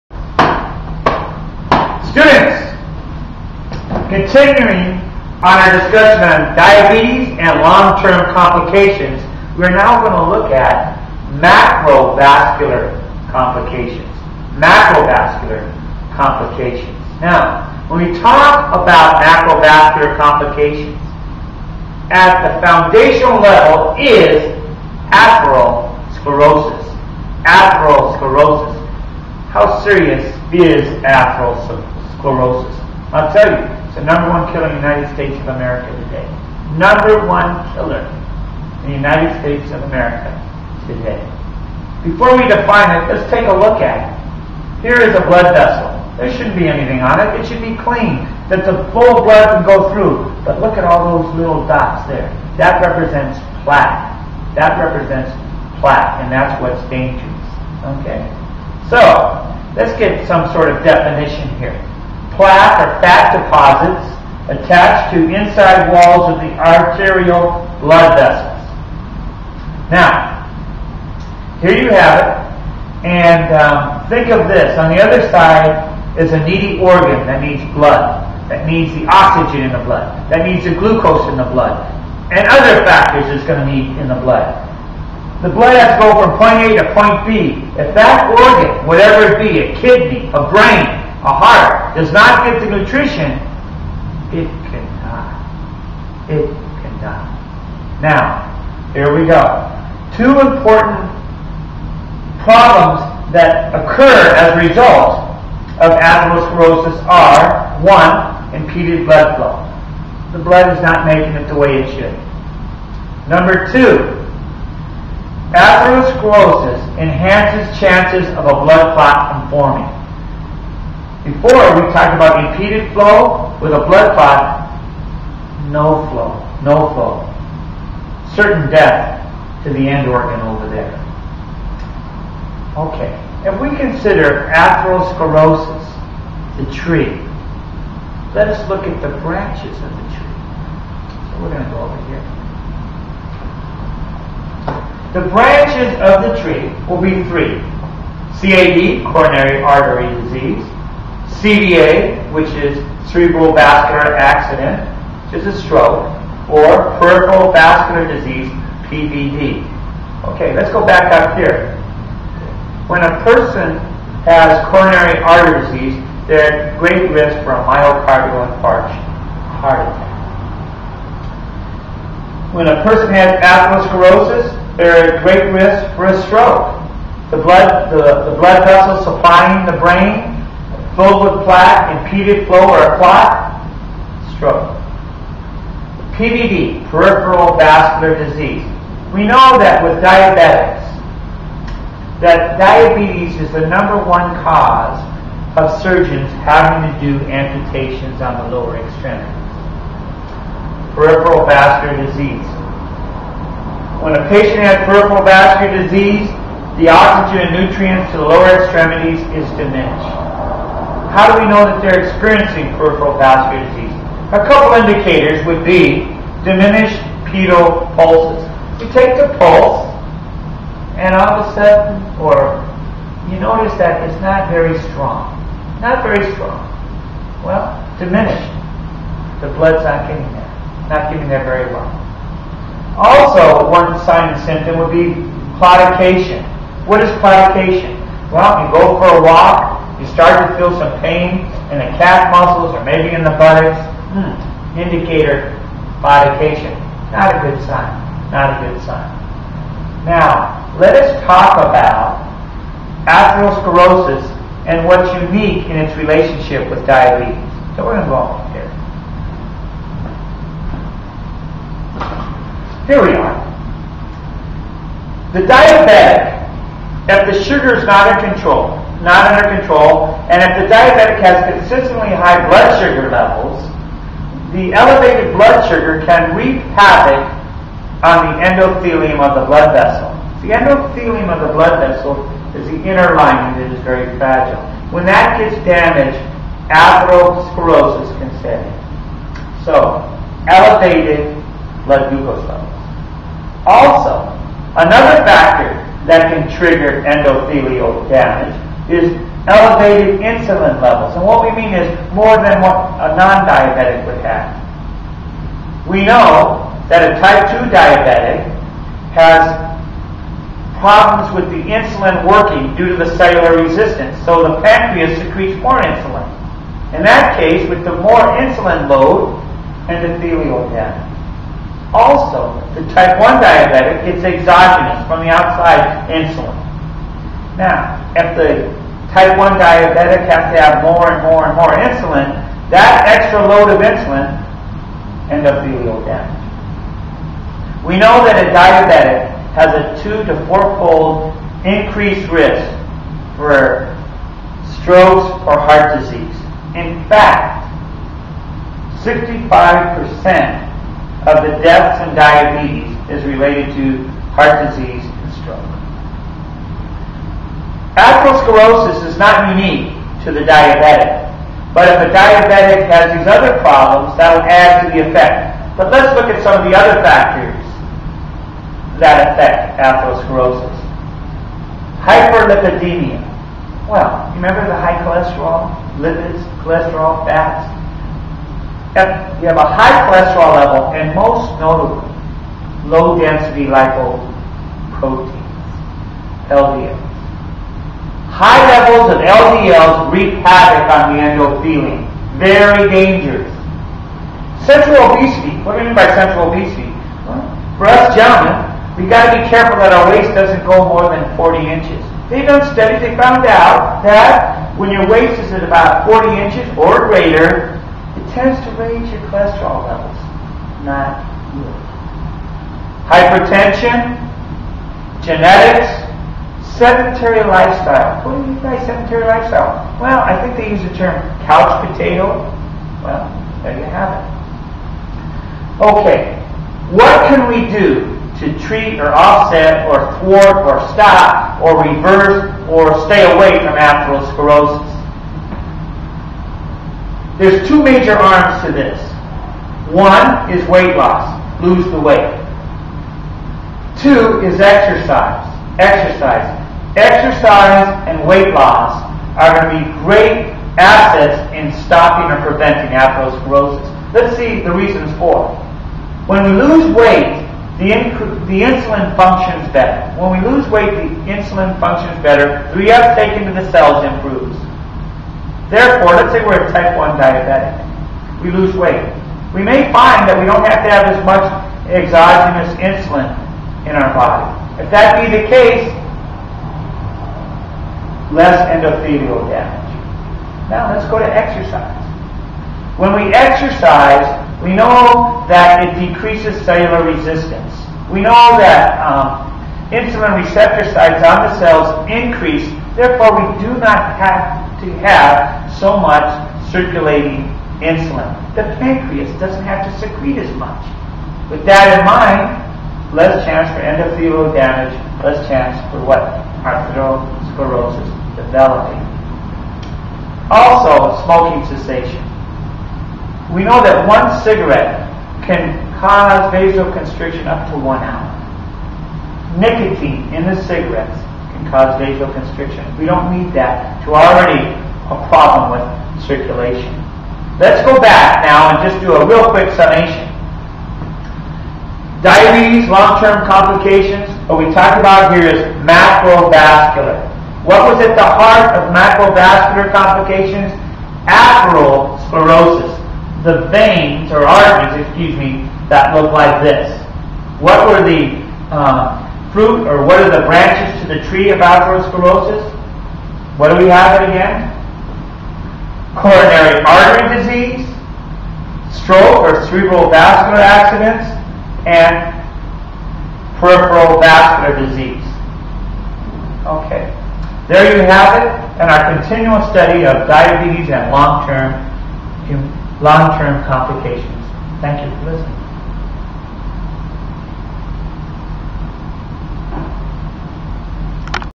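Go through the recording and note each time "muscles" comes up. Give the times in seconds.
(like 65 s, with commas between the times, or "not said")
242 s.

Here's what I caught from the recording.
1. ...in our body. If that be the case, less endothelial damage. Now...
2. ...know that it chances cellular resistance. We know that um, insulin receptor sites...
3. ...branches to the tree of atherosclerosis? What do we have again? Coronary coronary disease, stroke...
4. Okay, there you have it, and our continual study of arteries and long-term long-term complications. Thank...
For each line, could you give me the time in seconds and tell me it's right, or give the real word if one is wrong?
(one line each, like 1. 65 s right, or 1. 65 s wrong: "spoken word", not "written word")
1. 473 s right
2. 484 s wrong: "decreases", not "chances"
3. 550 s wrong: "artery", not "coronary"
4. 566 s wrong: "diabetes", not "arteries".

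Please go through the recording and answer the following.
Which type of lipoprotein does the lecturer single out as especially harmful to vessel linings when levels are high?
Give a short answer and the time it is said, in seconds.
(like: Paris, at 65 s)
Low density lipoproteins, at 382 s.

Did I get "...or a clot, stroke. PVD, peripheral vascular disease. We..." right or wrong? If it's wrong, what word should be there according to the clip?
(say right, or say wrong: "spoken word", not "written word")
right.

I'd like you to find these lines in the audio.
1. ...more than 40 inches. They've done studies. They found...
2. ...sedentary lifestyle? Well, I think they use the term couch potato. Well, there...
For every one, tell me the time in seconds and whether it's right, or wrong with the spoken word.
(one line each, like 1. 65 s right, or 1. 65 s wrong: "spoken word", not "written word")
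1. 400 s right
2. 418 s right.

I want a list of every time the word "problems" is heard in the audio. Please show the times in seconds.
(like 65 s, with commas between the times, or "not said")
102 s, 310 s, 363 s, 525 s.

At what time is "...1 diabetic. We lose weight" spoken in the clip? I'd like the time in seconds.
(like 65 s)
466 s.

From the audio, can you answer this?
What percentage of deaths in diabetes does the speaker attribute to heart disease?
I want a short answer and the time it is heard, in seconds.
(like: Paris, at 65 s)
65%, at 349 s.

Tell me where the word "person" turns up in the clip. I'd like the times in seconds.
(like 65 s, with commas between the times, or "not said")
163 s, 172 s.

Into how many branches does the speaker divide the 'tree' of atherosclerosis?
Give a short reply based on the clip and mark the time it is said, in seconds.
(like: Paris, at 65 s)
3, at 145 s.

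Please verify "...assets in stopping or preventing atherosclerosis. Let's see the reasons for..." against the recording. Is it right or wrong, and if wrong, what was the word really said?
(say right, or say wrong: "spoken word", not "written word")
right.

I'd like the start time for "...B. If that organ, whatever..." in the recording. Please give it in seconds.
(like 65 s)
87 s.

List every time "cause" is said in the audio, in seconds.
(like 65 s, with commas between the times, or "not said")
194 s, 515 s, 521 s.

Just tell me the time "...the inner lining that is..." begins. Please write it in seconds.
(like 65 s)
282 s.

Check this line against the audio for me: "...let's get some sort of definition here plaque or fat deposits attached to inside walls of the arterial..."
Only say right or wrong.
right.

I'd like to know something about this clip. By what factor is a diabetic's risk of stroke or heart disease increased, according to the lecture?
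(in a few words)
2 to 4 fold.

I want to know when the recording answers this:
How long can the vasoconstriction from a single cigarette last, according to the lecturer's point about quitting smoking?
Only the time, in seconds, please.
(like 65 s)
517 s.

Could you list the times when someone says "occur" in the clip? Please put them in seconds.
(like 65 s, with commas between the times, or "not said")
103 s.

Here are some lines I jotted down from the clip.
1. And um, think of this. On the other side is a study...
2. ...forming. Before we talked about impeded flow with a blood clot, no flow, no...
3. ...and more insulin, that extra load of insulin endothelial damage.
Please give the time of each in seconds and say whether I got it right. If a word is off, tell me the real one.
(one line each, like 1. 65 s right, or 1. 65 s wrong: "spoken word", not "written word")
1. 73 s wrong: "needy", not "study"
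2. 119 s right
3. 331 s right.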